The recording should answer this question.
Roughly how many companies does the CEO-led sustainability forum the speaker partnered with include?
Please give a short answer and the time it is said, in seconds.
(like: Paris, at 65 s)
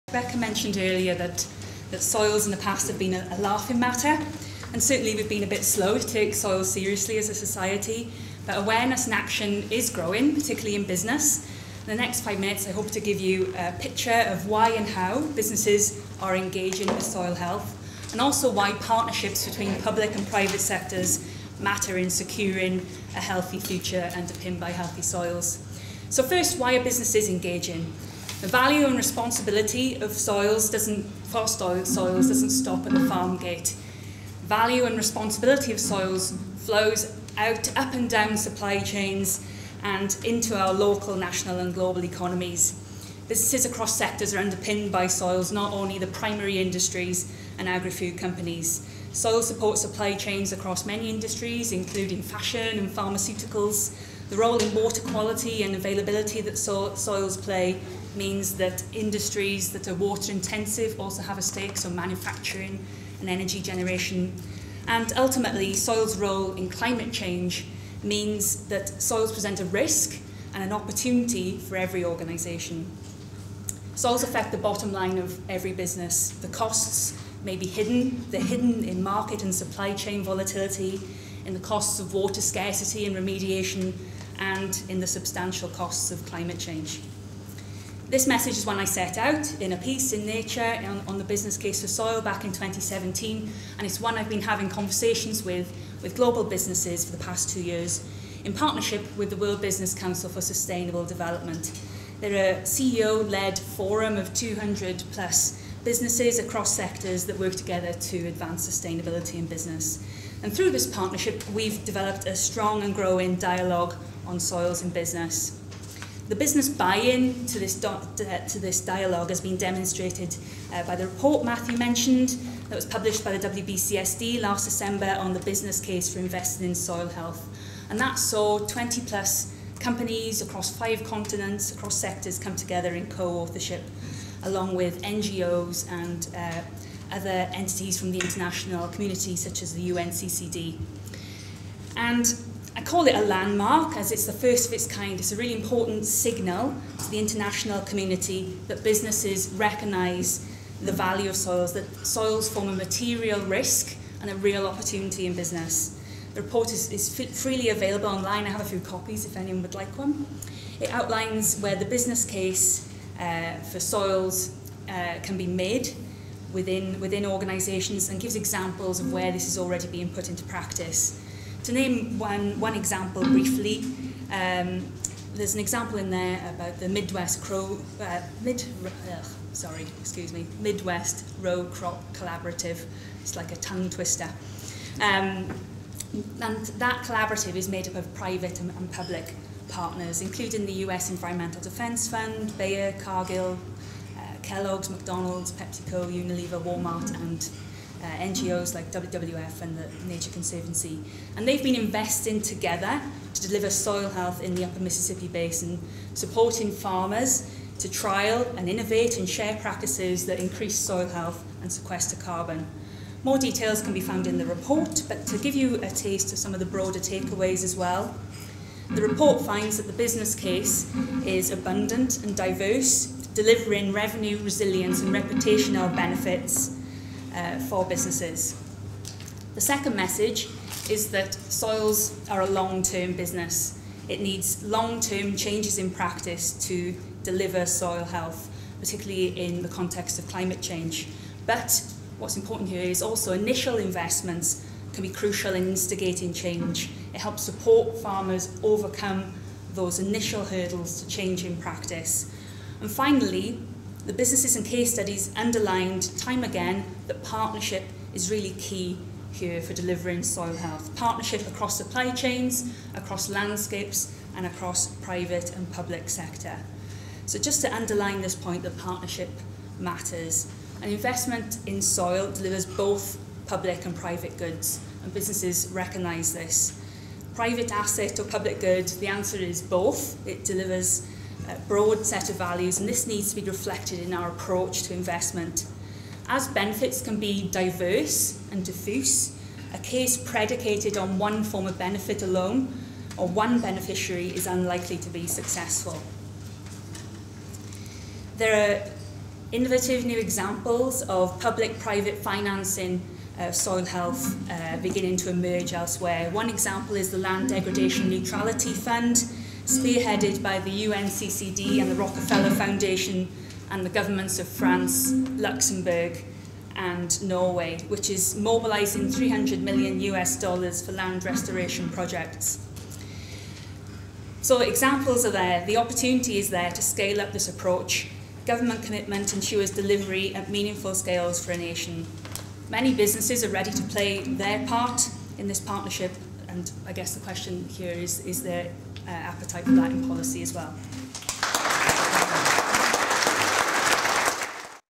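200 plus, at 104 s.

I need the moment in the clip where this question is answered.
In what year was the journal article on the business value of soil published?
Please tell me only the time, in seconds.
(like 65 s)
92 s.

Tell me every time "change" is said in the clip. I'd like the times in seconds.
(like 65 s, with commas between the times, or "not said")
67 s, 86 s, 235 s, 240 s, 246 s, 251 s.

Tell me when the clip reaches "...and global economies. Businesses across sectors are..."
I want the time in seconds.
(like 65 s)
41 s.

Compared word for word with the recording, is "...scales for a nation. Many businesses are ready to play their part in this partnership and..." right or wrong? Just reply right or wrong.
right.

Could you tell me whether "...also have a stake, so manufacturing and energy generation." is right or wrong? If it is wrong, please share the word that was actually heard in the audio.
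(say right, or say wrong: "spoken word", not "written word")
right.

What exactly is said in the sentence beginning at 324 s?
So examples are there, the opportunity is there to scale up this approach.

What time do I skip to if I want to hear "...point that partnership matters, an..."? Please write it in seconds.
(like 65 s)
268 s.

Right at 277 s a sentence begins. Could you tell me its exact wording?
Private asset or public good, the answer is both.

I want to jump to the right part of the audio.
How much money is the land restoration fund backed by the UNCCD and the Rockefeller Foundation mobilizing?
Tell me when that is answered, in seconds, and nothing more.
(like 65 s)
319 s.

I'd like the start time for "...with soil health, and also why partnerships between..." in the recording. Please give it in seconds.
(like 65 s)
16 s.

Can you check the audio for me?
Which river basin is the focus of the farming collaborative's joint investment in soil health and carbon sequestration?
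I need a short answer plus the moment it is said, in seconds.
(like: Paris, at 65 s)
Upper Mississippi Basin, at 204 s.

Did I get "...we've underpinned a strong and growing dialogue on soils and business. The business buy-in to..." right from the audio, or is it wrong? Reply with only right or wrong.
wrong.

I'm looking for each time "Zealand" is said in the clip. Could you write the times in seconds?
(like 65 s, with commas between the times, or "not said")
not said.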